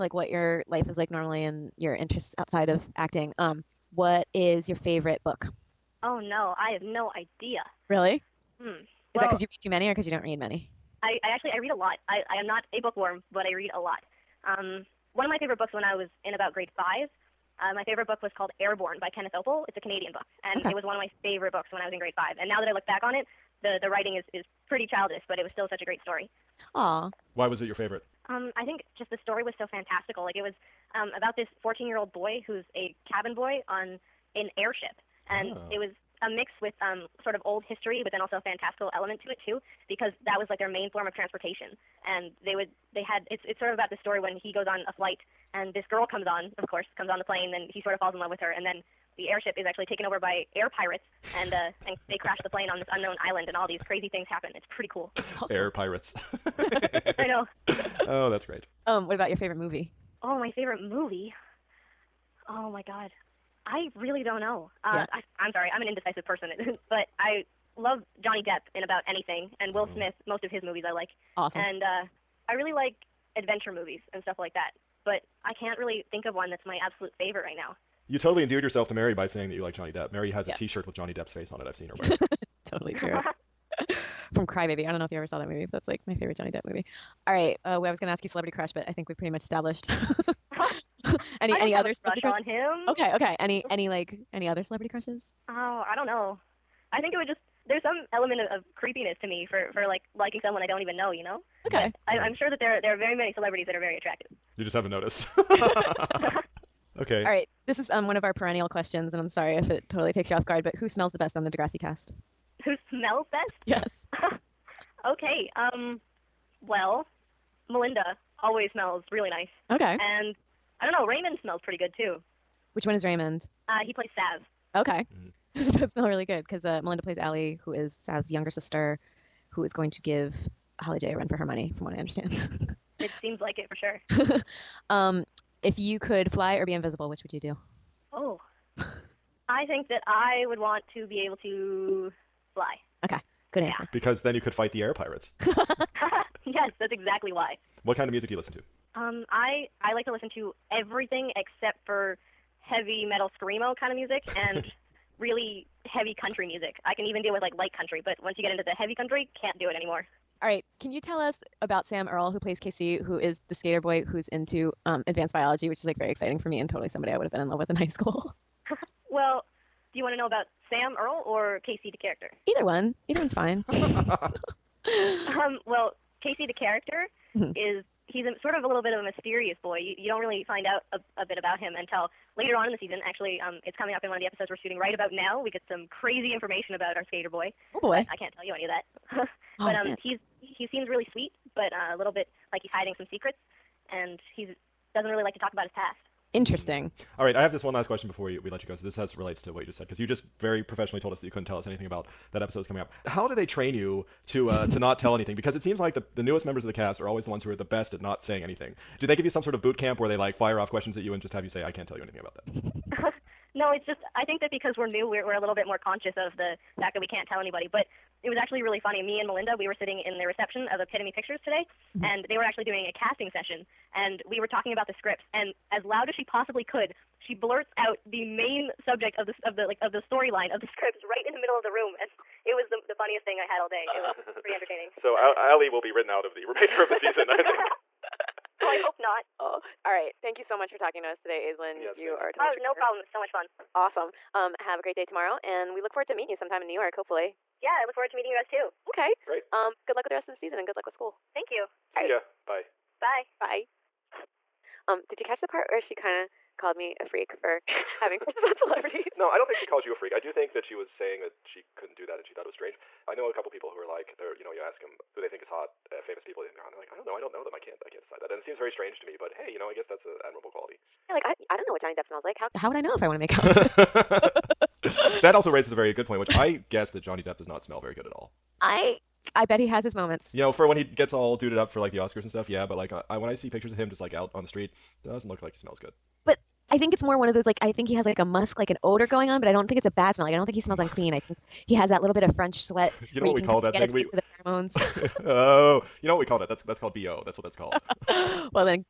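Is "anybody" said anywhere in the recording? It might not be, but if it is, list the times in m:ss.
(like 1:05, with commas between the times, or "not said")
3:37.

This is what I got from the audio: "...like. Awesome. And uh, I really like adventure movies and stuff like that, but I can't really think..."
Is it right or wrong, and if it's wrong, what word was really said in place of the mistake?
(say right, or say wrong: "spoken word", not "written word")
right.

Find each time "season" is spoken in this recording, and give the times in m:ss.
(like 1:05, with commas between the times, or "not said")
3:02, 3:56, 4:10.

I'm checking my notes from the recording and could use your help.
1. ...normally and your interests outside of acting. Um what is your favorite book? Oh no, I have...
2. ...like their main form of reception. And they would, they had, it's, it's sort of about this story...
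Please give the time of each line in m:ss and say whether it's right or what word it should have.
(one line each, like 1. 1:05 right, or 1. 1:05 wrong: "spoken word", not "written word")
1. 0:01 right
2. 0:40 wrong: "transportation", not "reception".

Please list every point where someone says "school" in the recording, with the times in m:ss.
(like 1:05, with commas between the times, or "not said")
2:47, 4:10.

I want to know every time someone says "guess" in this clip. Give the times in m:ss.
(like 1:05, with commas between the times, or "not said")
4:29, 4:36.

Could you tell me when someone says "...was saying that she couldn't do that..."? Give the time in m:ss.
4:20.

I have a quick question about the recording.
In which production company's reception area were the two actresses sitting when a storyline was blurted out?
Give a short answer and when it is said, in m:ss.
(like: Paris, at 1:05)
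Epitome Pictures, at 3:40.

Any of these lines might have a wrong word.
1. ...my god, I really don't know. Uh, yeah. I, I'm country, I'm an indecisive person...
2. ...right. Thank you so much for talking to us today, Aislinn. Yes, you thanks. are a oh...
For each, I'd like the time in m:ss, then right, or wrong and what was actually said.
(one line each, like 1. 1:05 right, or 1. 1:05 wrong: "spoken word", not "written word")
1. 1:02 wrong: "sorry", not "country"
2. 3:59 right.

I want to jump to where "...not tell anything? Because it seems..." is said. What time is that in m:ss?
3:24.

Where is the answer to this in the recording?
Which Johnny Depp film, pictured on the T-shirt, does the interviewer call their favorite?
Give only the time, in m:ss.
1:24.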